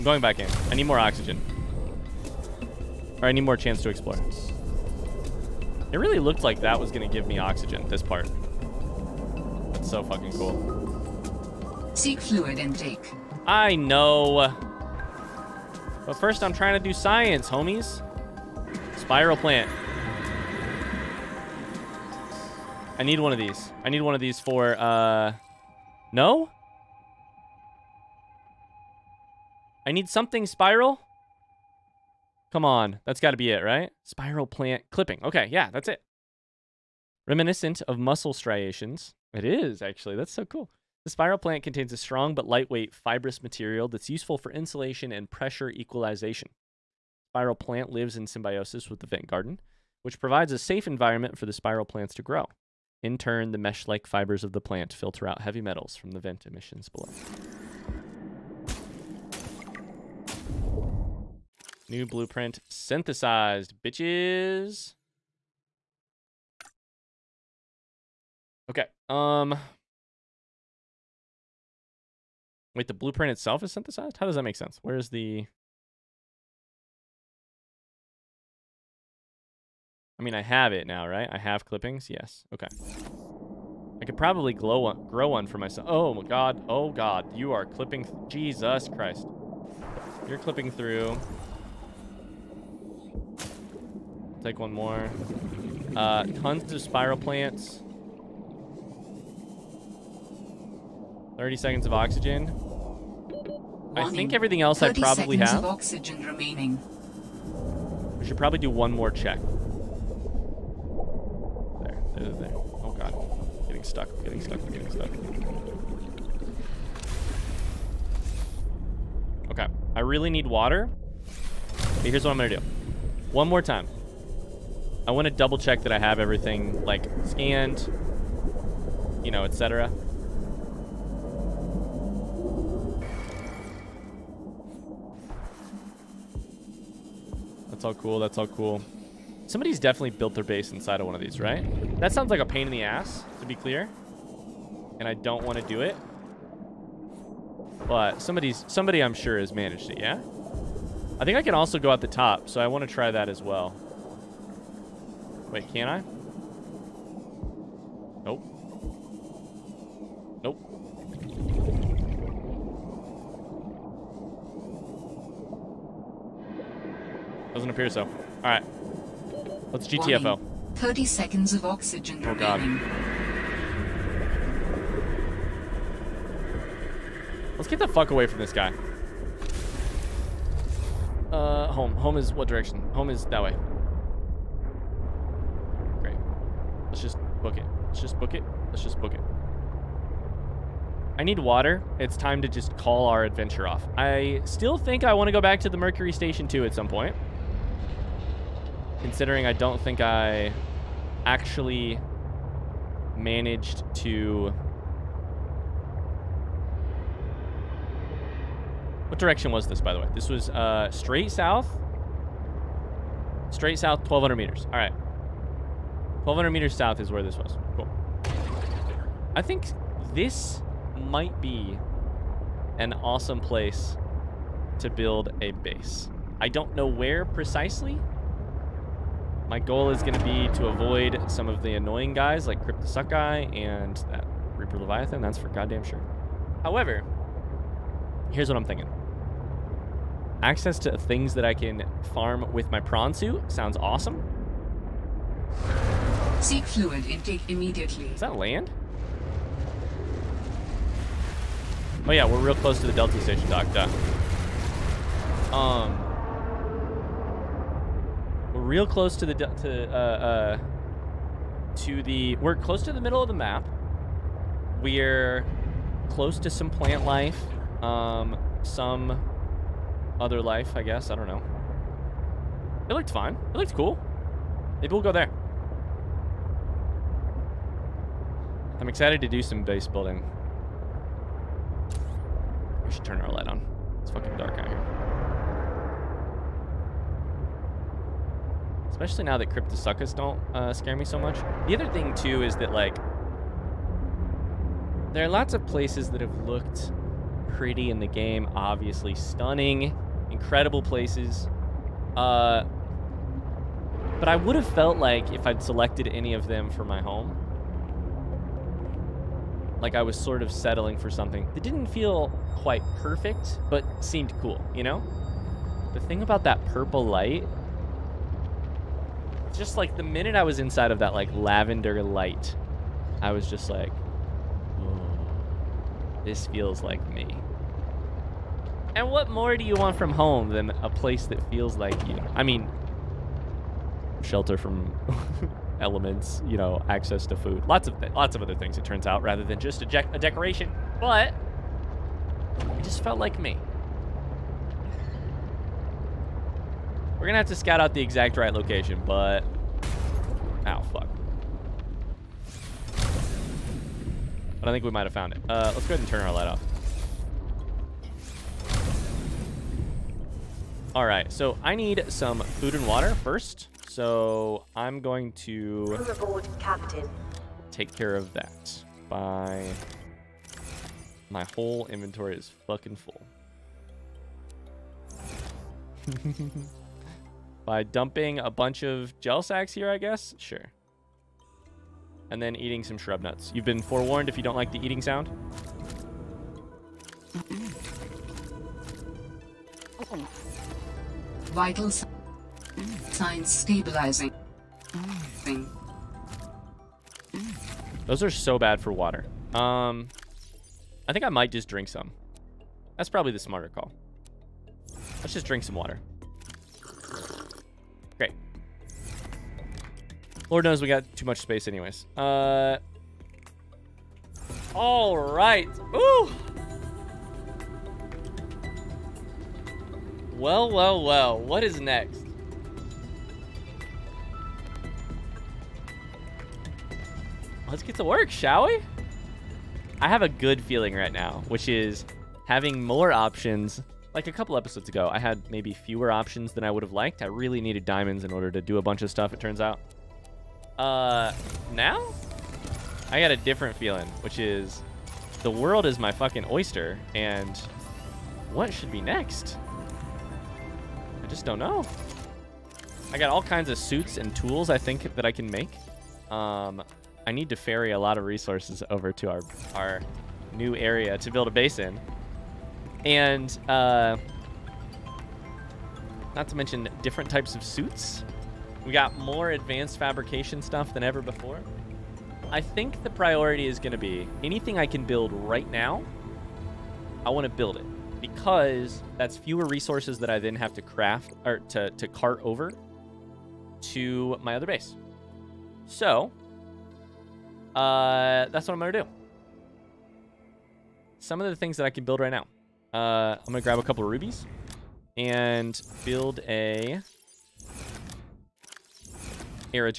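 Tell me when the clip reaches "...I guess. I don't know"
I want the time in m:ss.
4:30.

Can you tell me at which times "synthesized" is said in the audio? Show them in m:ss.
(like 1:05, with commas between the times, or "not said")
1:02, 1:13.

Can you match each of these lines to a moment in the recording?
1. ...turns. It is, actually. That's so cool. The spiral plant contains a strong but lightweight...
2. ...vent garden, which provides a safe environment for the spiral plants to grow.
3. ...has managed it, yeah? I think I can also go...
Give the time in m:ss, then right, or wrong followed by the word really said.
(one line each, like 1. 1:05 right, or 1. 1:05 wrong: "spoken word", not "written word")
1. 0:38 wrong: "striations", not "turns"
2. 0:49 right
3. 2:29 right.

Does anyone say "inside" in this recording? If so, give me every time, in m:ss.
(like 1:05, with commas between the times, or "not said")
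2:20, 5:20.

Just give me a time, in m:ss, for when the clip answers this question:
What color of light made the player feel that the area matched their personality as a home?
5:21.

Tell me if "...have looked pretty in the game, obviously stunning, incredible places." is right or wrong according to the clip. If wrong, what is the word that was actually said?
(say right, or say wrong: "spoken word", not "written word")
right.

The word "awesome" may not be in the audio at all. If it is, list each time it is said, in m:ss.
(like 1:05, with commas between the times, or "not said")
3:42, 4:03.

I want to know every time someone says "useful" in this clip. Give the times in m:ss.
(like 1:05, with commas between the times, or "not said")
0:44.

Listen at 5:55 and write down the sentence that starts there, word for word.
Uh, let's go ahead and turn our light off.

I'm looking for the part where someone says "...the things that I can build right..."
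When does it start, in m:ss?
8:11.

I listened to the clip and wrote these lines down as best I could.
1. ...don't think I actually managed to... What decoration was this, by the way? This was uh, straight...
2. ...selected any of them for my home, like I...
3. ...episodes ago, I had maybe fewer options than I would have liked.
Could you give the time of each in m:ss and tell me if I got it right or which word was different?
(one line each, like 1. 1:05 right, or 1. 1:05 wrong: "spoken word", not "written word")
1. 3:19 wrong: "direction", not "decoration"
2. 5:05 right
3. 7:14 right.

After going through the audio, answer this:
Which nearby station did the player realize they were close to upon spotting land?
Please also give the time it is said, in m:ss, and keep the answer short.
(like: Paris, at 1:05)
Delta Station, at 4:12.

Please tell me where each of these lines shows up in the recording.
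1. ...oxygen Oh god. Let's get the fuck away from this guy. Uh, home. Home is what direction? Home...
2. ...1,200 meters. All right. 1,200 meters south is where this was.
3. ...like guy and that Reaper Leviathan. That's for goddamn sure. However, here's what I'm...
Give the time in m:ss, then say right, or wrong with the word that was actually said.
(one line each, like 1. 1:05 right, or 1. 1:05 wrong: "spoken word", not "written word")
1. 2:51 right
2. 3:33 right
3. 3:52 right.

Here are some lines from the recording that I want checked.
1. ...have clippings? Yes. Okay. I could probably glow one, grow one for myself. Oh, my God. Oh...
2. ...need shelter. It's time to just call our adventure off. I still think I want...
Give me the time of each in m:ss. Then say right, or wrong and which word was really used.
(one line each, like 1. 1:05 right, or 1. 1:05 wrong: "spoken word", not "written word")
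1. 1:21 right
2. 3:11 wrong: "water", not "shelter".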